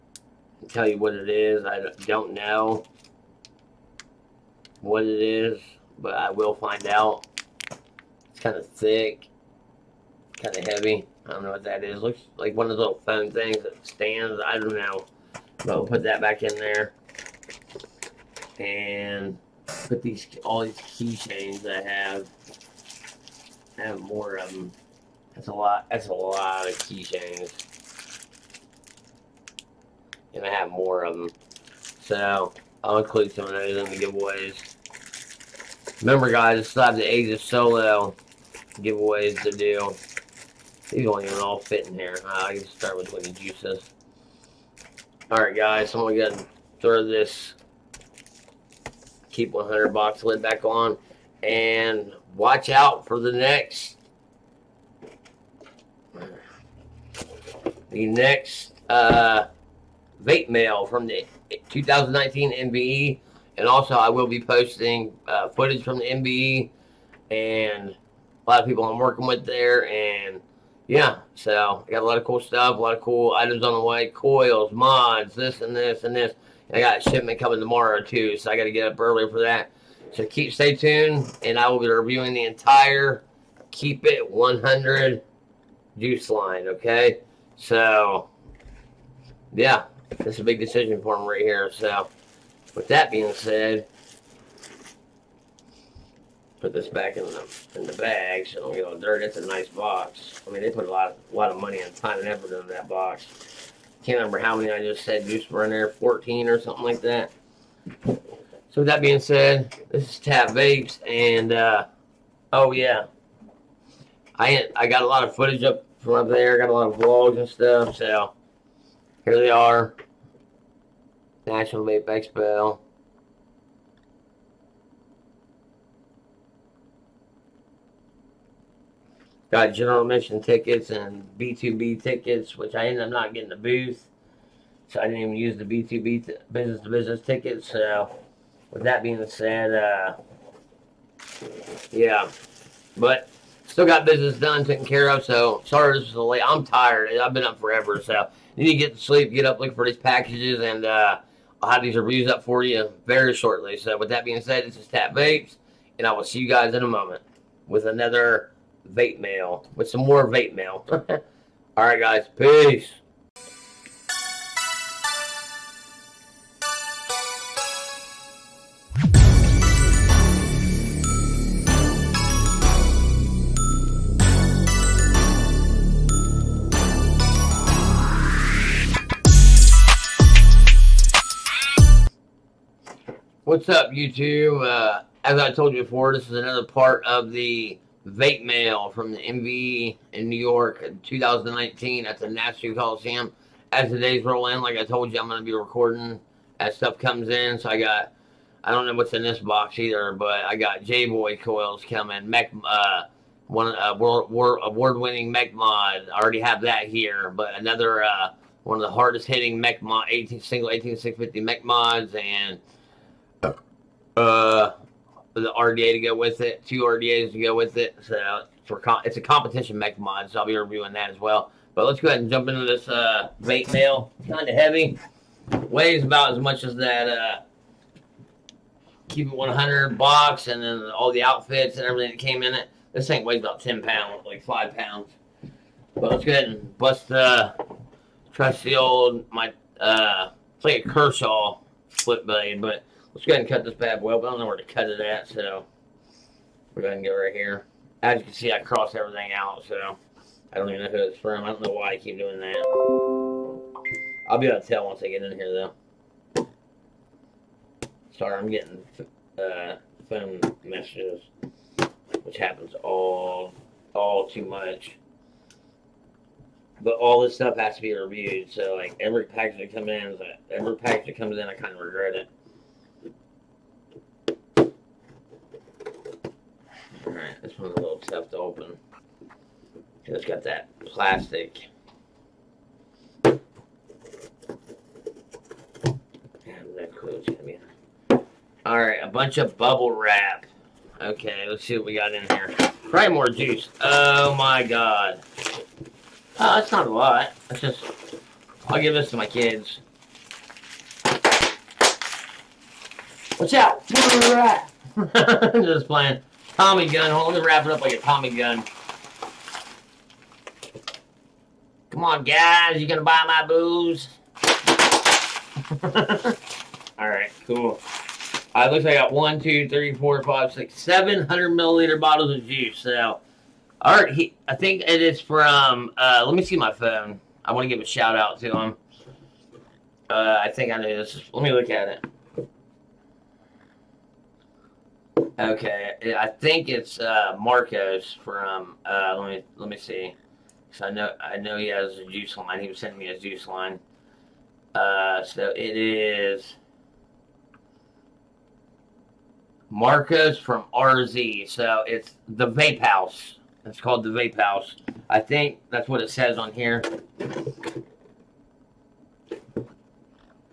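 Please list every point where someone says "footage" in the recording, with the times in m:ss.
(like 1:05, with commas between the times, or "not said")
1:05, 1:55.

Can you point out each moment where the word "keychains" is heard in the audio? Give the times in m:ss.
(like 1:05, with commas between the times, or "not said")
0:20, 0:26.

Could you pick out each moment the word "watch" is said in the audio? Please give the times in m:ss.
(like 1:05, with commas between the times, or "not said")
0:52, 5:03.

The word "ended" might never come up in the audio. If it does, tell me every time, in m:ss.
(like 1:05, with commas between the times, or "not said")
2:12.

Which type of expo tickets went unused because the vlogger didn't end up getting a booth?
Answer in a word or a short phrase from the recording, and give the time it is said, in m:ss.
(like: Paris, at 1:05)
B2B tickets, at 2:15.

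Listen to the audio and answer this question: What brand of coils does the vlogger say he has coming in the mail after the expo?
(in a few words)
J-Boy.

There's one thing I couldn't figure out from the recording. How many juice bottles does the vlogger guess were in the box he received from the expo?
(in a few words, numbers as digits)
14.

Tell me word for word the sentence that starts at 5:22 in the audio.
So, all right, he, I think it is from.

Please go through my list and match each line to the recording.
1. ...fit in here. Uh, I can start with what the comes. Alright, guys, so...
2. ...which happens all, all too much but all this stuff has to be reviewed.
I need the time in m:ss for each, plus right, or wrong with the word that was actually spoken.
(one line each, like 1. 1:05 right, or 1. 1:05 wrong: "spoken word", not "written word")
1. 0:41 wrong: "juices", not "comes"
2. 4:22 right.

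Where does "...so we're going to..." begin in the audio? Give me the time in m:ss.
4:05.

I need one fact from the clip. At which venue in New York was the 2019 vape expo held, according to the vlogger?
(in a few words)
Nassau Coliseum.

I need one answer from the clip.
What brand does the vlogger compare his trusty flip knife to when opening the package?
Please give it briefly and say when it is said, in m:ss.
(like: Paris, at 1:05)
Kershaw, at 4:00.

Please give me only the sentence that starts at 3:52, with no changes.
This thing weighs about 10 pounds, like five pounds.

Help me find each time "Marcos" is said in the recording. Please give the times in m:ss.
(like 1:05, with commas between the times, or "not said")
5:37, 5:49.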